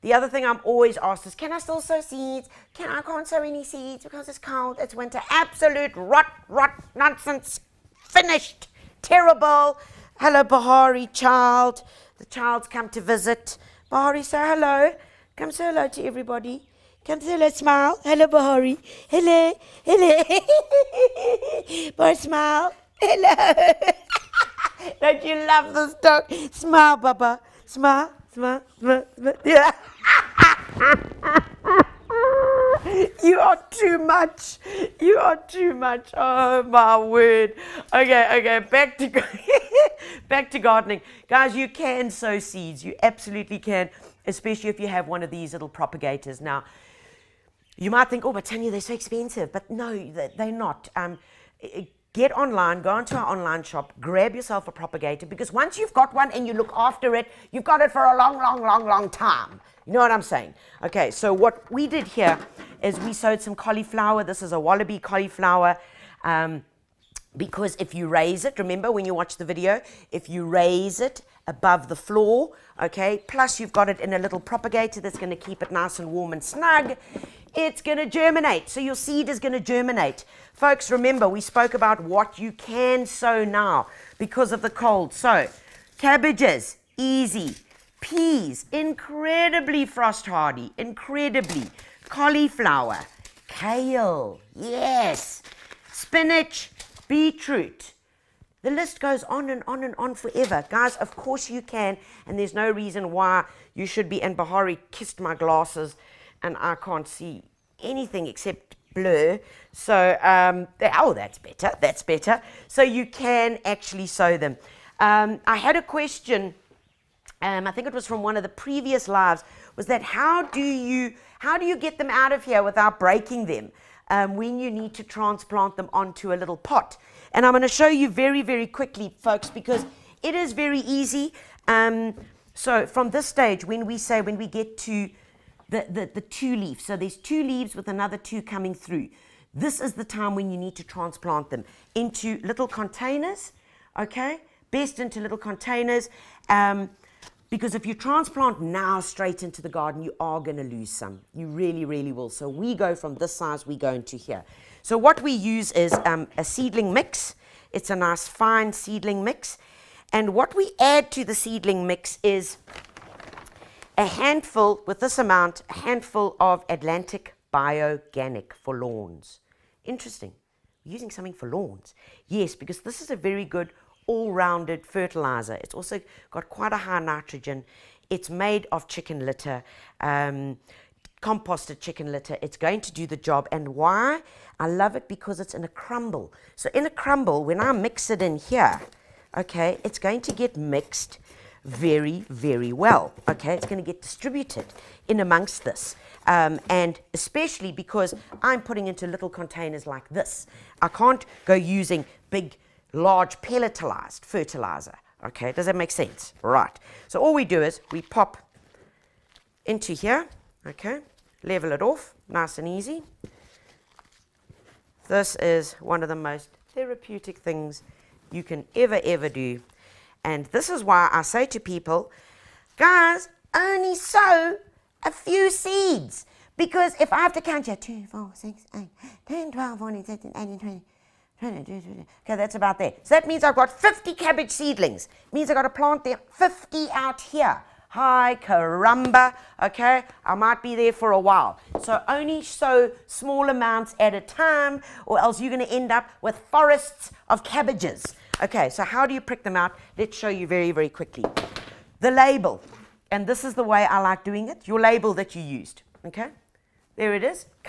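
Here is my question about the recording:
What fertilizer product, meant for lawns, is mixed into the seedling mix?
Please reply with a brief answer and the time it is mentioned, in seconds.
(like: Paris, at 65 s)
Atlantic Bioganic, at 166 s.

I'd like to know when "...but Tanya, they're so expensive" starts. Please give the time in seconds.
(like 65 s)
48 s.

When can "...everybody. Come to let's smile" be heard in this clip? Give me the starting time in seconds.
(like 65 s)
16 s.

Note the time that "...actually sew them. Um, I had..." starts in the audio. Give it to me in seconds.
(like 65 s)
113 s.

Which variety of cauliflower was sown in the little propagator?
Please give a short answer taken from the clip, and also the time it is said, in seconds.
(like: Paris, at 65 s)
Wallaby, at 64 s.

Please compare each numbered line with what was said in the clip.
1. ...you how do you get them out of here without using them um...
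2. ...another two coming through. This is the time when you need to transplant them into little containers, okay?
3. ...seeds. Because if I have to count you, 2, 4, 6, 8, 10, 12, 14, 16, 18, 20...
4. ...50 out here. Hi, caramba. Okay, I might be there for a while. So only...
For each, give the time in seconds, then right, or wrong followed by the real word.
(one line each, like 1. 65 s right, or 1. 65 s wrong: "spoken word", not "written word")
1. 120 s wrong: "breaking", not "using"
2. 137 s right
3. 225 s right
4. 236 s right.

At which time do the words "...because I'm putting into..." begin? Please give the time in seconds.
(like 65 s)
197 s.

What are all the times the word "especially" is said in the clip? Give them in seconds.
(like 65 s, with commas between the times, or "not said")
44 s, 197 s.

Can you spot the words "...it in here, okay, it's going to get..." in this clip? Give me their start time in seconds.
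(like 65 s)
188 s.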